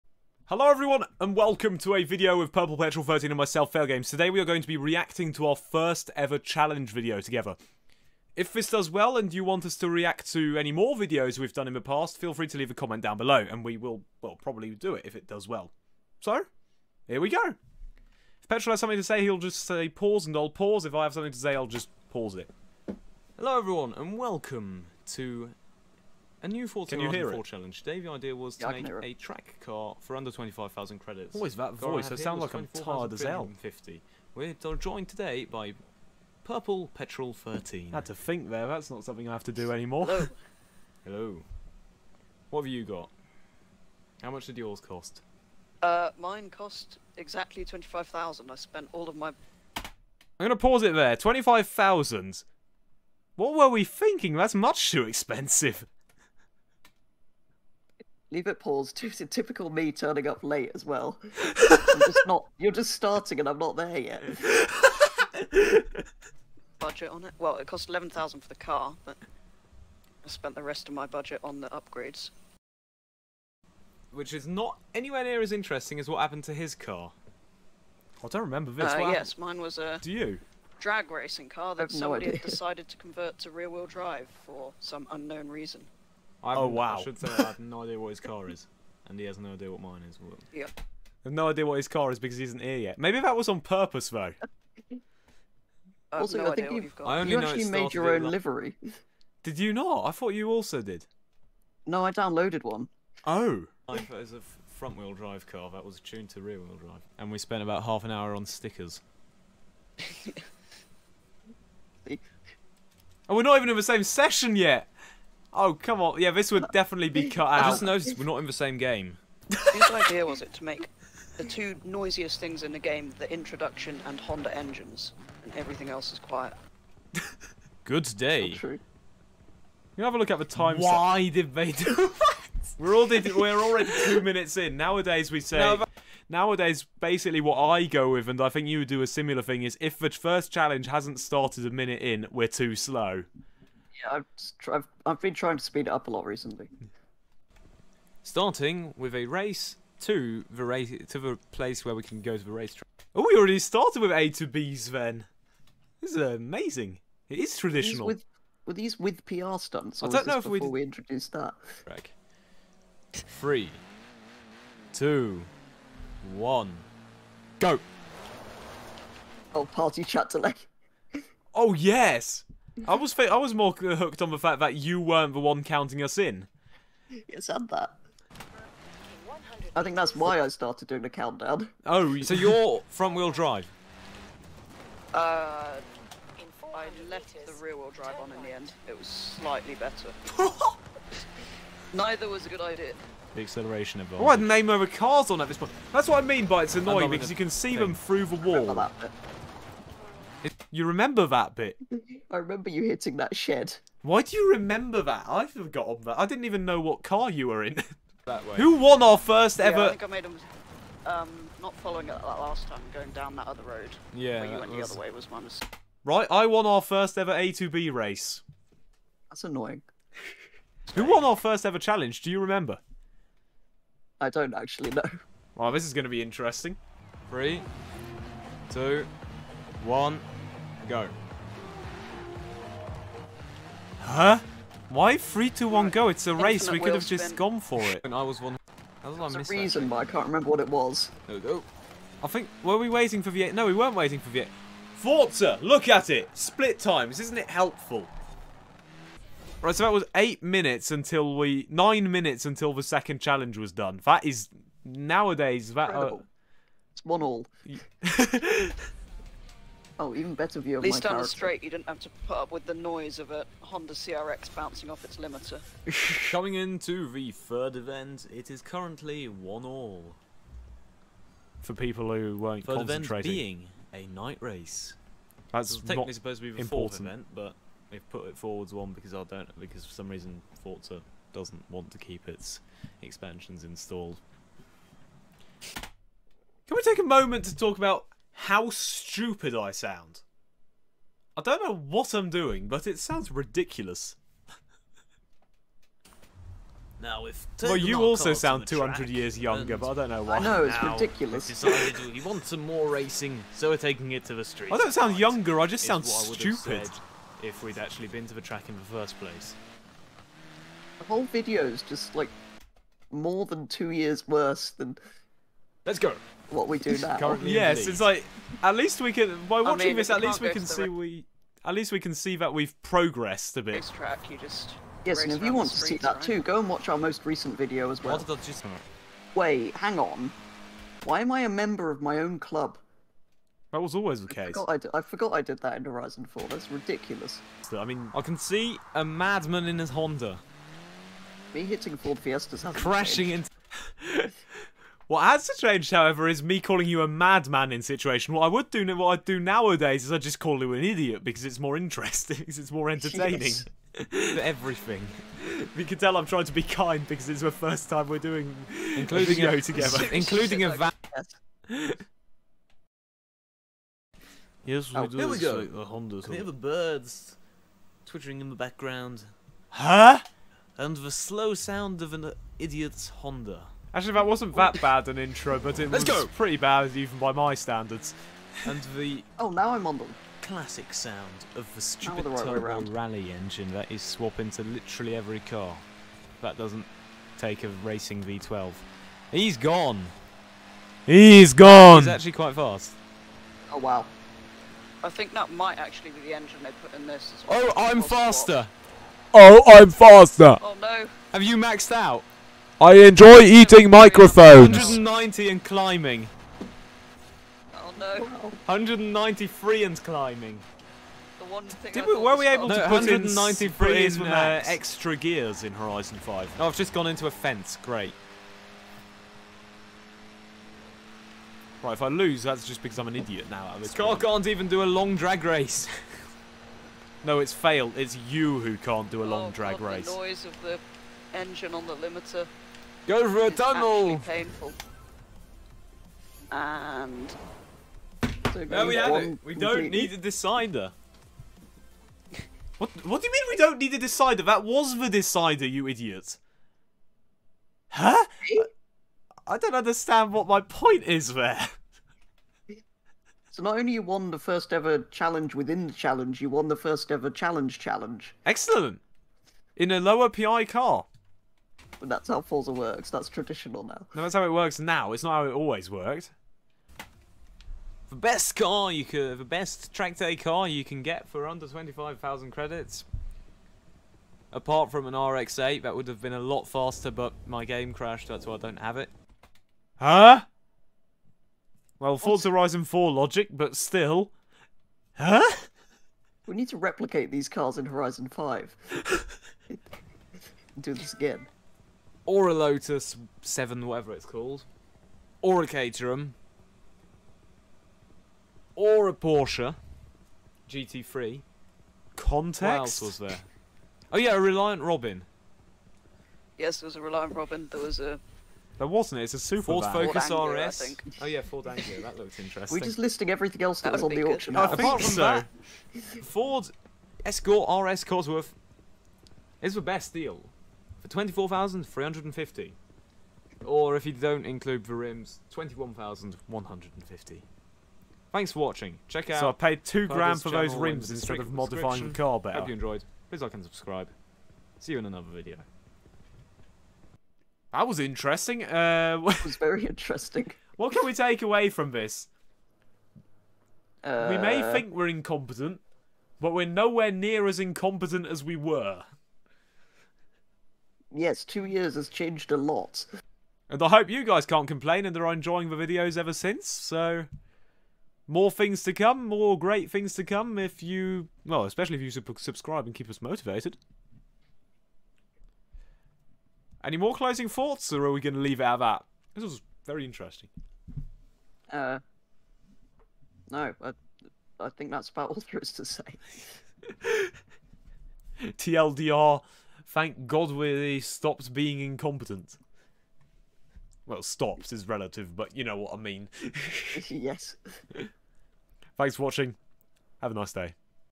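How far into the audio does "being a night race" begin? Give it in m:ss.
4:33.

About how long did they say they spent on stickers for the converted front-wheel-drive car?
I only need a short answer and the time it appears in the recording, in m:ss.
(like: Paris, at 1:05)
half an hour, at 1:47.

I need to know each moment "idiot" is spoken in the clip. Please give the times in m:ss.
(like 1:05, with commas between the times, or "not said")
5:50, 6:12, 7:03, 7:25.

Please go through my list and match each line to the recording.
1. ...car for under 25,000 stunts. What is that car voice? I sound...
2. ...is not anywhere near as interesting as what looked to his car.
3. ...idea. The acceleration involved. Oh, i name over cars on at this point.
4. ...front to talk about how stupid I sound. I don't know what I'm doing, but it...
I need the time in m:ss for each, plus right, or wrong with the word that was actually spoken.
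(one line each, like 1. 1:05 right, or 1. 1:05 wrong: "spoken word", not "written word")
1. 0:29 wrong: "credits", not "stunts"
2. 1:14 wrong: "happened", not "looked"
3. 3:12 right
4. 4:47 wrong: "moment", not "front".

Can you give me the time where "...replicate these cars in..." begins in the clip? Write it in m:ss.
8:06.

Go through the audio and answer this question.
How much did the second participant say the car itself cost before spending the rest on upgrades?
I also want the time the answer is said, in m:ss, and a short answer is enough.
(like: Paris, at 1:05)
11,000, at 1:07.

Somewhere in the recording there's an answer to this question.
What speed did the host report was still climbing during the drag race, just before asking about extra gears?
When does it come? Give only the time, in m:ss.
6:48.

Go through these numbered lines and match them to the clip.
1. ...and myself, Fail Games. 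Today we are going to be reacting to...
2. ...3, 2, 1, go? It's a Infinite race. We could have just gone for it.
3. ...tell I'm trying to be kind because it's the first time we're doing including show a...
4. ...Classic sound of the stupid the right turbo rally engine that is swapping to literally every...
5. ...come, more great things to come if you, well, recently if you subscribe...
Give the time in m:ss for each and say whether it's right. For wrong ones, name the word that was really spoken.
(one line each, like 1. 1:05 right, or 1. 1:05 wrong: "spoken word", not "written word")
1. 0:03 right
2. 3:55 right
3. 5:55 right
4. 6:20 right
5. 9:18 wrong: "especially", not "recently".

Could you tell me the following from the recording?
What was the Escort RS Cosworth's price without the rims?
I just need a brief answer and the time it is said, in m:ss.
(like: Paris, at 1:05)
21,150, at 8:45.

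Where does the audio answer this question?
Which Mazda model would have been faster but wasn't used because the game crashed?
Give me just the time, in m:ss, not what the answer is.
7:55.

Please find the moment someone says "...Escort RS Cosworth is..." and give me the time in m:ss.
8:37.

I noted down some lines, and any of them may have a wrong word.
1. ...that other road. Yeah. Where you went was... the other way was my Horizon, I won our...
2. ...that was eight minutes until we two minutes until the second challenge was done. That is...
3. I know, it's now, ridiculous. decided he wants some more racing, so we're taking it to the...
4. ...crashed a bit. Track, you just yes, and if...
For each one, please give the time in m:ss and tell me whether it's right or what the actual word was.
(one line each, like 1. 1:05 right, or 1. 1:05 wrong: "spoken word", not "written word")
1. 3:33 wrong: "Right", not "Horizon"
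2. 4:09 wrong: "nine", not "two"
3. 5:00 right
4. 5:22 wrong: "progressed", not "crashed".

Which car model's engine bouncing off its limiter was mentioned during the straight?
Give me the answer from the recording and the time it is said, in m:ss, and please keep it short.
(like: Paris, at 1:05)
Honda CRX, at 4:23.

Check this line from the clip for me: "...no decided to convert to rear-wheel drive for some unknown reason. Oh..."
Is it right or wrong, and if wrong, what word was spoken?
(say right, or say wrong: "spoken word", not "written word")
right.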